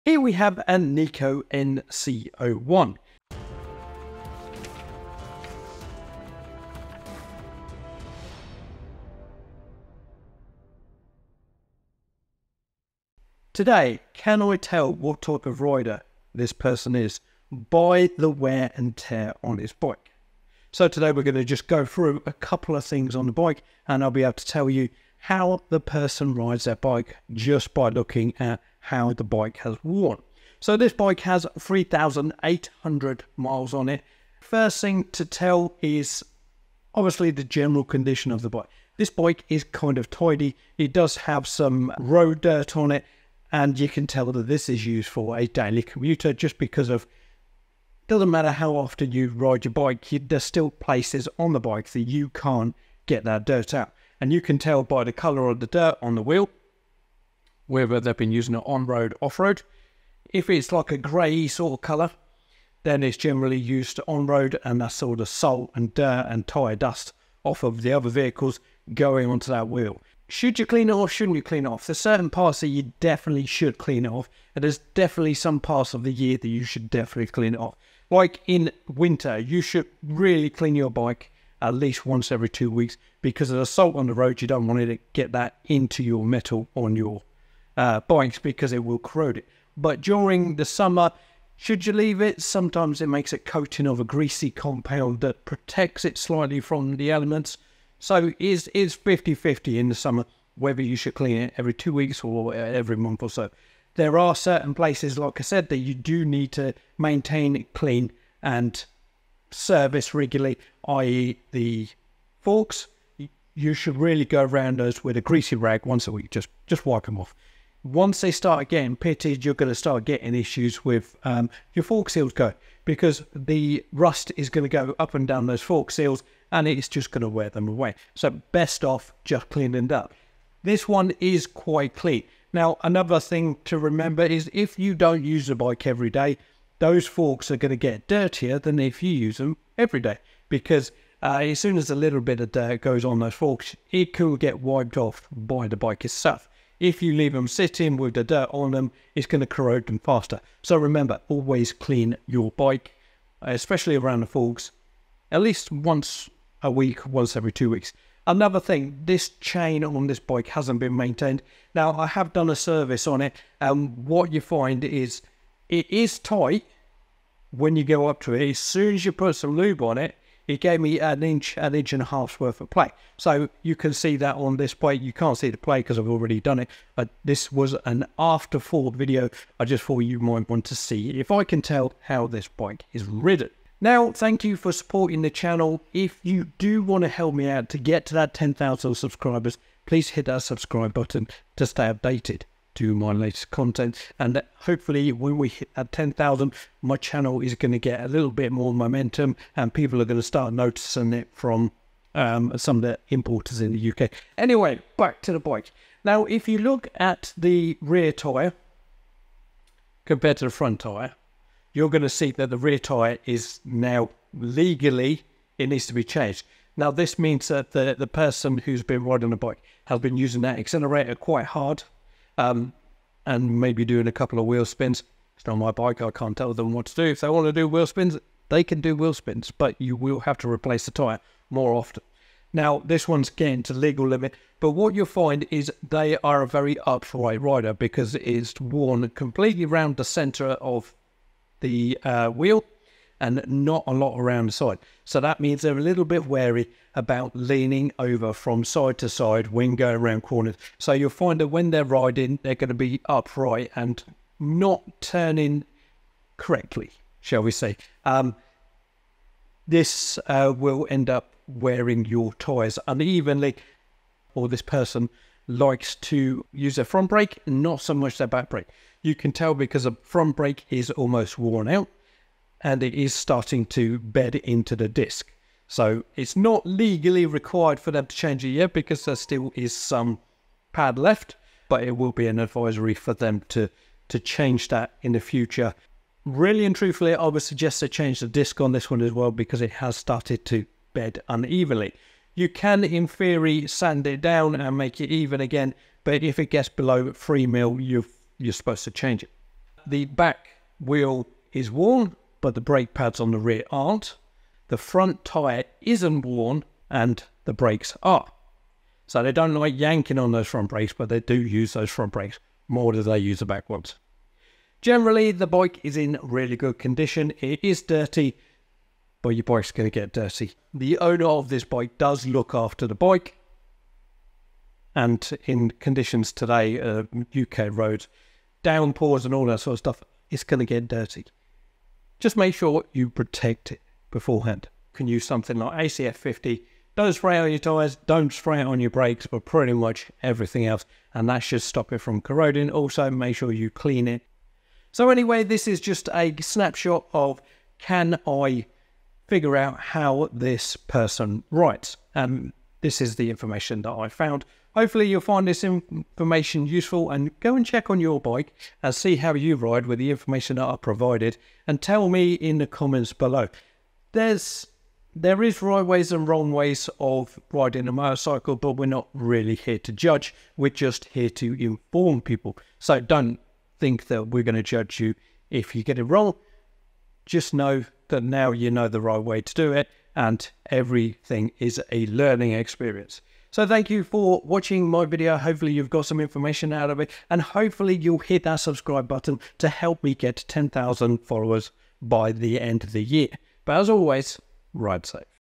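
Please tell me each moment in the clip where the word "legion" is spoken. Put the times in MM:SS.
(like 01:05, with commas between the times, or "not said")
not said.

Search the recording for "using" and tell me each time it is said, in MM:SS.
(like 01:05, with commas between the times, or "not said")
00:58, 03:40.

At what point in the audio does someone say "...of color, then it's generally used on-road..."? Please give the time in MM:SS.
01:01.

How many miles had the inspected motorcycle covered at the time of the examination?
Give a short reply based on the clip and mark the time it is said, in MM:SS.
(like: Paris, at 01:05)
3,800, at 00:31.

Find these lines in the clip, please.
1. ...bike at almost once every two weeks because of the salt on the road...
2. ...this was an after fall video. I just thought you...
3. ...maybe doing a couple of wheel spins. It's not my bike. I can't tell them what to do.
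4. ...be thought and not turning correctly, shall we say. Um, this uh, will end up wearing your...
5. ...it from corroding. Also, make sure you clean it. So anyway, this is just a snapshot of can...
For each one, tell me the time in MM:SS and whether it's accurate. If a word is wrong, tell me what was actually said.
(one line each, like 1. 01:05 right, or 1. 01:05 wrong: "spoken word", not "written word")
1. 01:20 wrong: "least", not "almost"
2. 02:57 right
3. 03:43 right
4. 04:12 wrong: "upright", not "thought"
5. 05:41 right.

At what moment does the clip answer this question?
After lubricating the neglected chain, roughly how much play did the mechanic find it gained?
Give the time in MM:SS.
02:51.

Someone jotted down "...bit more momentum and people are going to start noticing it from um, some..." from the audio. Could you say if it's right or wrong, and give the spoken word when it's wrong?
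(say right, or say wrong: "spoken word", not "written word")
right.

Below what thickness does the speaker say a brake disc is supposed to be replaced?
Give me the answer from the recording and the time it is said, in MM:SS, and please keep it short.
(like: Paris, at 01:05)
3 mm, at 04:57.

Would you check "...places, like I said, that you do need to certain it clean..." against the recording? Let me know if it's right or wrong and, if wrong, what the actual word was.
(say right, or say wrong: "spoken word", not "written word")
wrong: "maintain", not "certain".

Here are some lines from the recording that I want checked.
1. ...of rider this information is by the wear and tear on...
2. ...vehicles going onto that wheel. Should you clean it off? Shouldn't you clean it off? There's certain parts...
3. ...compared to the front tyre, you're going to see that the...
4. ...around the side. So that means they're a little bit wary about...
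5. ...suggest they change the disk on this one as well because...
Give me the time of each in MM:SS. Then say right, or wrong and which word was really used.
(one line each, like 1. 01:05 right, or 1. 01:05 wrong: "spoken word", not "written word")
1. 00:15 wrong: "person", not "information"
2. 01:08 right
3. 03:30 right
4. 04:04 right
5. 04:47 right.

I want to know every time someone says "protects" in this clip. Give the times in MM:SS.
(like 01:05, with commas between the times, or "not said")
01:35, 05:33.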